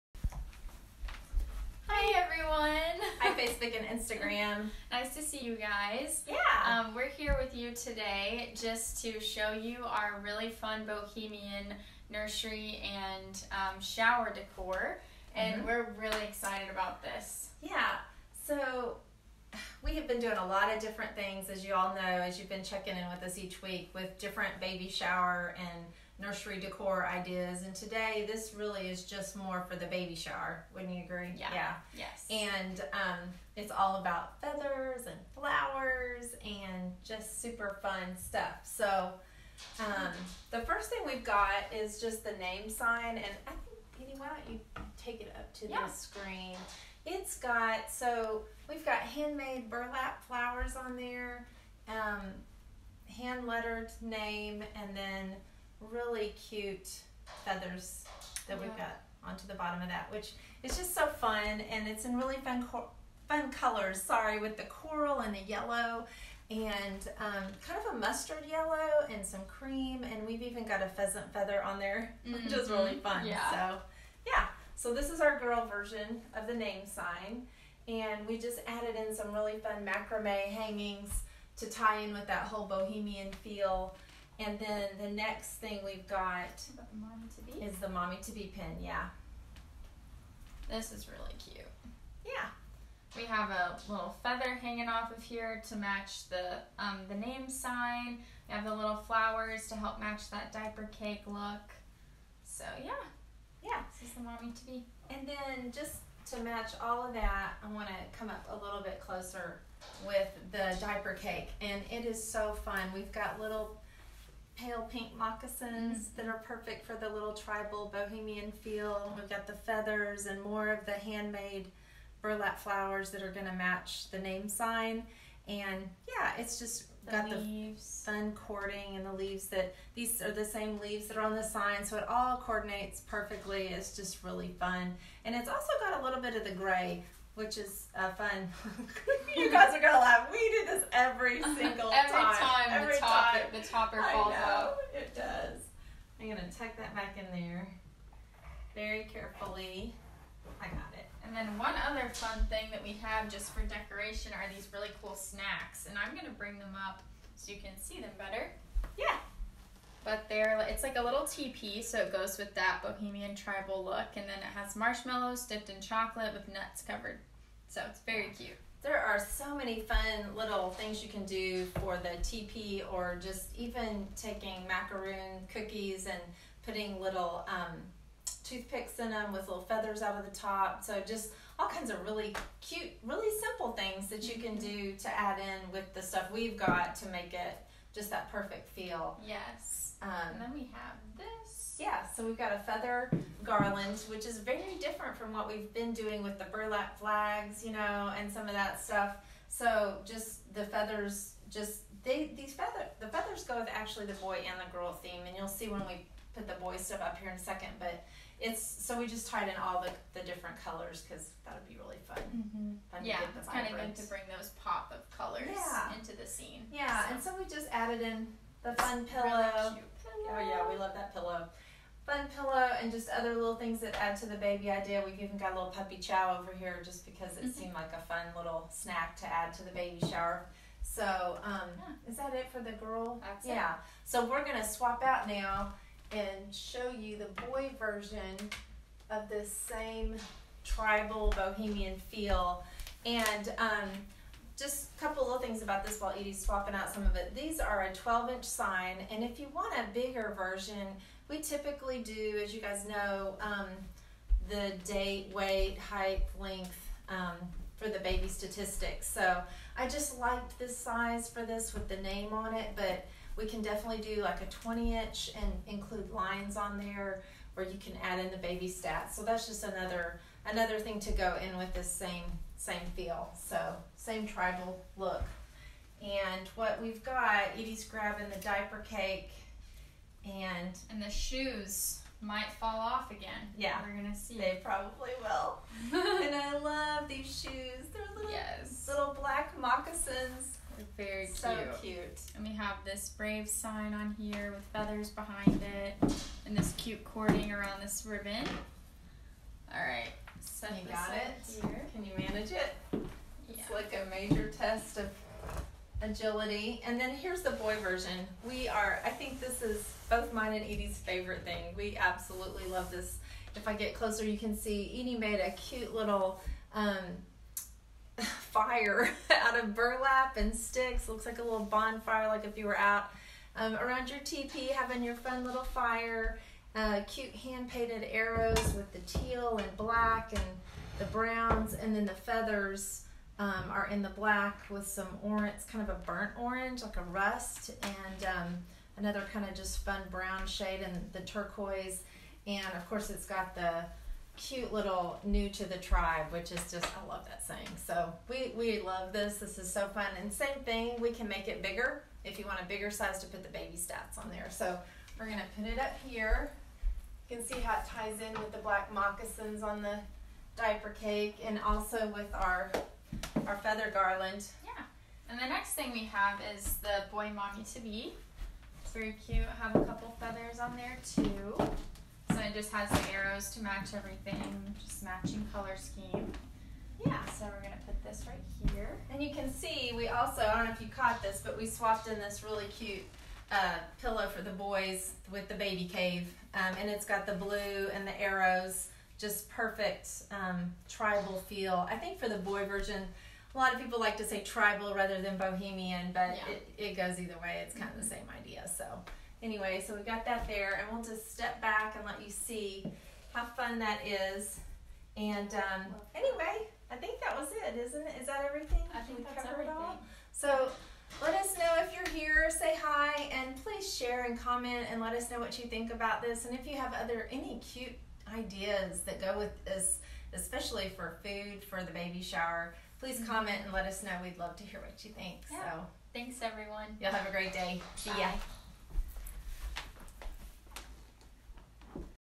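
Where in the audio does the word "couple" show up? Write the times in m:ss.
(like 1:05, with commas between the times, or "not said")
4:05, 6:09.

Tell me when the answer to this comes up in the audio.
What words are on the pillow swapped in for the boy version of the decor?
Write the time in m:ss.
6:25.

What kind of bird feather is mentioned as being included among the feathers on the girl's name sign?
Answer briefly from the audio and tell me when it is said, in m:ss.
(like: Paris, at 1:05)
Pheasant feather, at 1:10.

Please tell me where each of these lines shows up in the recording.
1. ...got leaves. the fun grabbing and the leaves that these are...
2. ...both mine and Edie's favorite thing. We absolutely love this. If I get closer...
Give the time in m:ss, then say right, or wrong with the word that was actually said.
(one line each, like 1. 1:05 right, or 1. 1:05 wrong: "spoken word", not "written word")
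1. 2:07 wrong: "cording", not "grabbing"
2. 5:10 right.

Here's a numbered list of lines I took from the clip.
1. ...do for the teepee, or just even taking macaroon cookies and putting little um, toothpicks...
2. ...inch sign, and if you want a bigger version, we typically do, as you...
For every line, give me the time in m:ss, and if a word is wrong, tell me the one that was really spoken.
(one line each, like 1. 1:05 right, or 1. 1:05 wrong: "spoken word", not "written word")
1. 2:51 right
2. 4:08 right.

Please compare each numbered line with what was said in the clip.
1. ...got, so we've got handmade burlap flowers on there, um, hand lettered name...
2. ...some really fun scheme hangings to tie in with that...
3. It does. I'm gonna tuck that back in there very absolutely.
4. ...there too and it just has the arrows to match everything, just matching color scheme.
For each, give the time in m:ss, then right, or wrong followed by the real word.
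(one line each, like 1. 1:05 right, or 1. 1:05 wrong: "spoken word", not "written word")
1. 0:47 right
2. 1:19 wrong: "macrame", not "scheme"
3. 2:24 wrong: "carefully", not "absolutely"
4. 6:10 right.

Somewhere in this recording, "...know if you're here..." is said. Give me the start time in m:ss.
6:51.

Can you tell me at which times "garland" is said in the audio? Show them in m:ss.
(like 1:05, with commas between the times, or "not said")
3:13, 6:03.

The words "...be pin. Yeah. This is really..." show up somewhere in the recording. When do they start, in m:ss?
1:28.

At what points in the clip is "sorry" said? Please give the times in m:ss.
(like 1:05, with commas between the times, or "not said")
1:04.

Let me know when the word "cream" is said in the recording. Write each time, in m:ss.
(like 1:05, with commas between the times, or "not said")
1:09.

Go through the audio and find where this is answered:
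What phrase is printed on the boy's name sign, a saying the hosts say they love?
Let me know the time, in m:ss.
5:45.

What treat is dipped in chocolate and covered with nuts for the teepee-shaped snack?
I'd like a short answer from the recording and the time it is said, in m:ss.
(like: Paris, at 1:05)
Marshmallows, at 2:44.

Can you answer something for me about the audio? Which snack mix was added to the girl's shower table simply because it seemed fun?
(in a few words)
Puppy chow.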